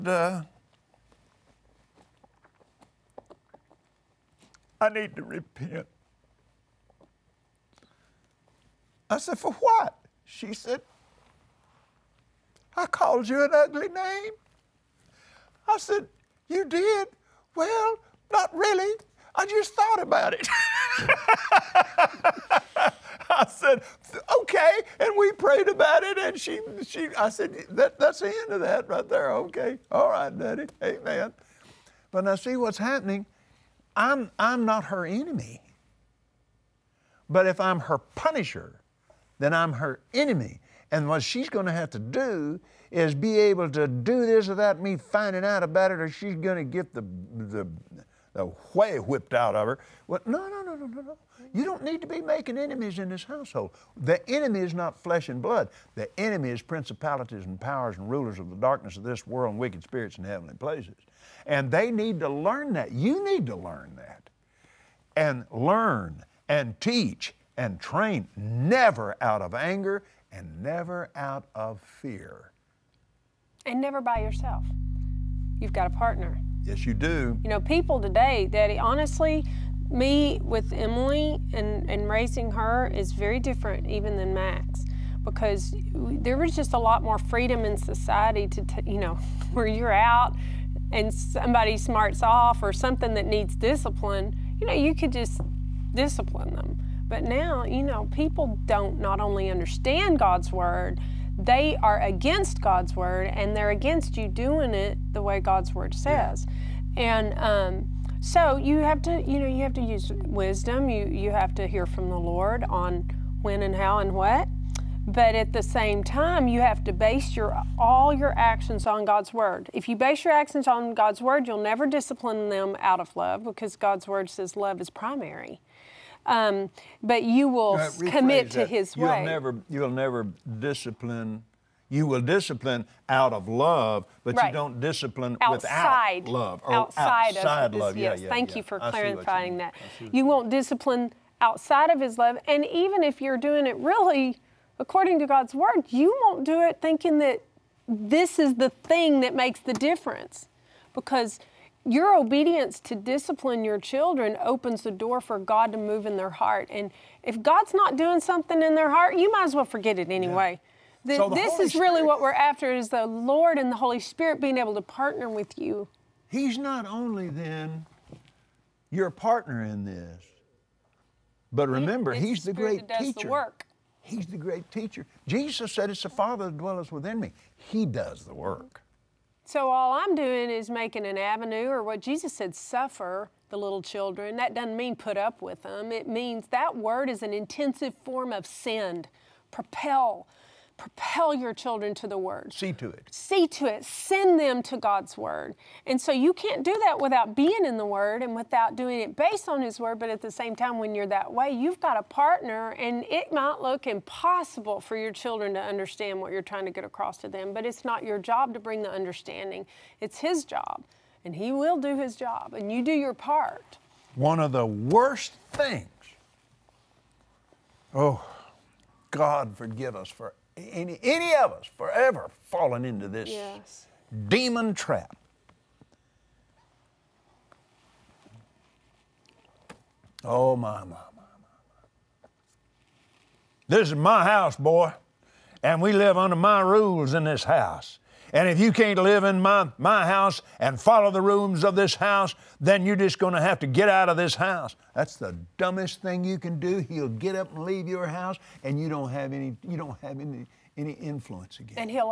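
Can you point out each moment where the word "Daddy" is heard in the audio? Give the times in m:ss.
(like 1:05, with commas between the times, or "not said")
0:30, 1:18.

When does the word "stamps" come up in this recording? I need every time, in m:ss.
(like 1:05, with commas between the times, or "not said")
not said.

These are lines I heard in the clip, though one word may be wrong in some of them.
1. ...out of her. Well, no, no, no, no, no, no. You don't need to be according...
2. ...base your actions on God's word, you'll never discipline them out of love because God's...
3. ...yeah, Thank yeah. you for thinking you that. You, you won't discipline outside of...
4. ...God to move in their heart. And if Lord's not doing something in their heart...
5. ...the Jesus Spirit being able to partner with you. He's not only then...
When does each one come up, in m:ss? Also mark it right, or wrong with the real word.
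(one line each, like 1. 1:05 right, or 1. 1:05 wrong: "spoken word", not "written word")
1. 0:49 wrong: "making", not "according"
2. 1:59 right
3. 2:18 wrong: "clarifying", not "thinking"
4. 2:35 wrong: "God", not "Lord"
5. 2:43 wrong: "Holy", not "Jesus".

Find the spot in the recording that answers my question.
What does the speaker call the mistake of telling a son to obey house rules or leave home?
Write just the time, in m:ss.
3:44.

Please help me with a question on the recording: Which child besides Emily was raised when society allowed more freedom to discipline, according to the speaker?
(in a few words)
Max.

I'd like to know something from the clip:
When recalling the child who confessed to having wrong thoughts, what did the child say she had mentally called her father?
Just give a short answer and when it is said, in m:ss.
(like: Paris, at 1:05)
an ugly name, at 0:13.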